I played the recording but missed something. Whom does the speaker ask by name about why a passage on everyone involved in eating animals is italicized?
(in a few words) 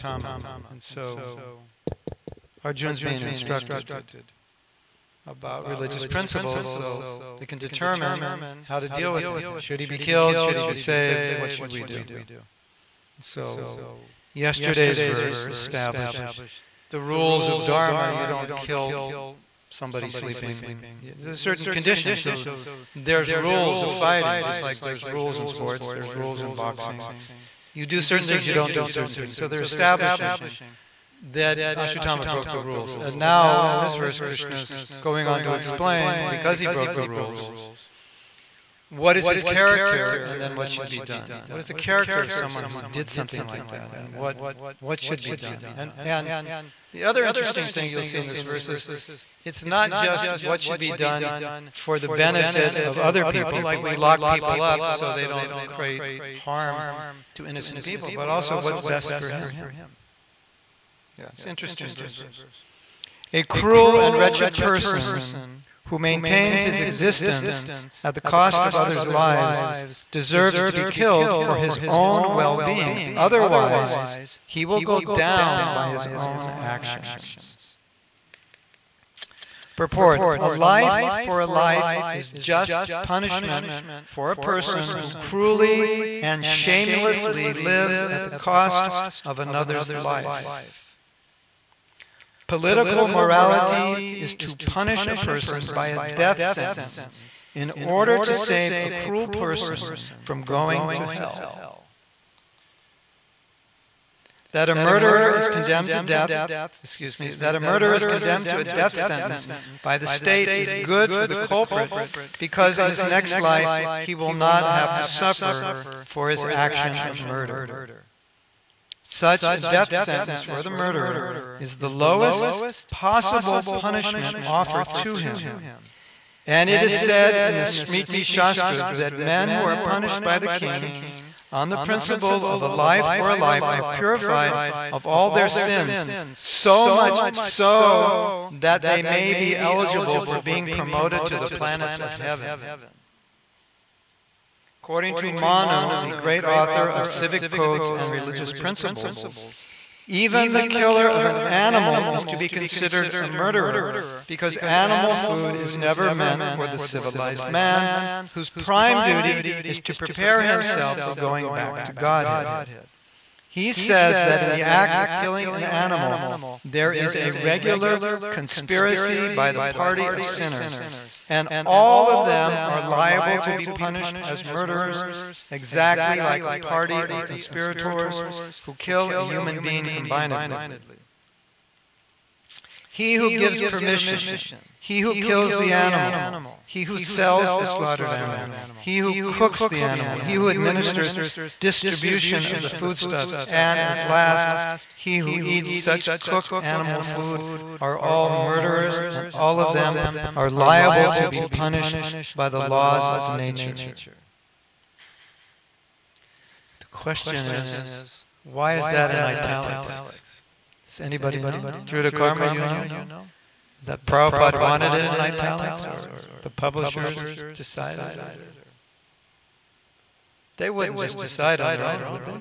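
Druta Karma.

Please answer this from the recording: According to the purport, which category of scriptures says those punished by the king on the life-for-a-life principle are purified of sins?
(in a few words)
Smriti Shastras.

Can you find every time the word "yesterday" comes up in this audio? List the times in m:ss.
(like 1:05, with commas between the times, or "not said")
0:14.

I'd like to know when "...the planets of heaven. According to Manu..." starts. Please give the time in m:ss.
2:21.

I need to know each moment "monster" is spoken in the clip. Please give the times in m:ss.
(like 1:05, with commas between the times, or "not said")
not said.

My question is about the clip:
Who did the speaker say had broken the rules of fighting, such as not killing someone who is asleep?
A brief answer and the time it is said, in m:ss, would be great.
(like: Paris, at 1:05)
Ashwatthama, at 0:31.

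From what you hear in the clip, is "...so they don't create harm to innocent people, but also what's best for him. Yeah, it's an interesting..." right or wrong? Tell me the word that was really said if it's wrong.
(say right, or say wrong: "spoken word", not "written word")
right.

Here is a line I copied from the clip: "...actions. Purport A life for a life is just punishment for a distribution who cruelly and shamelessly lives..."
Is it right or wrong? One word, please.
wrong.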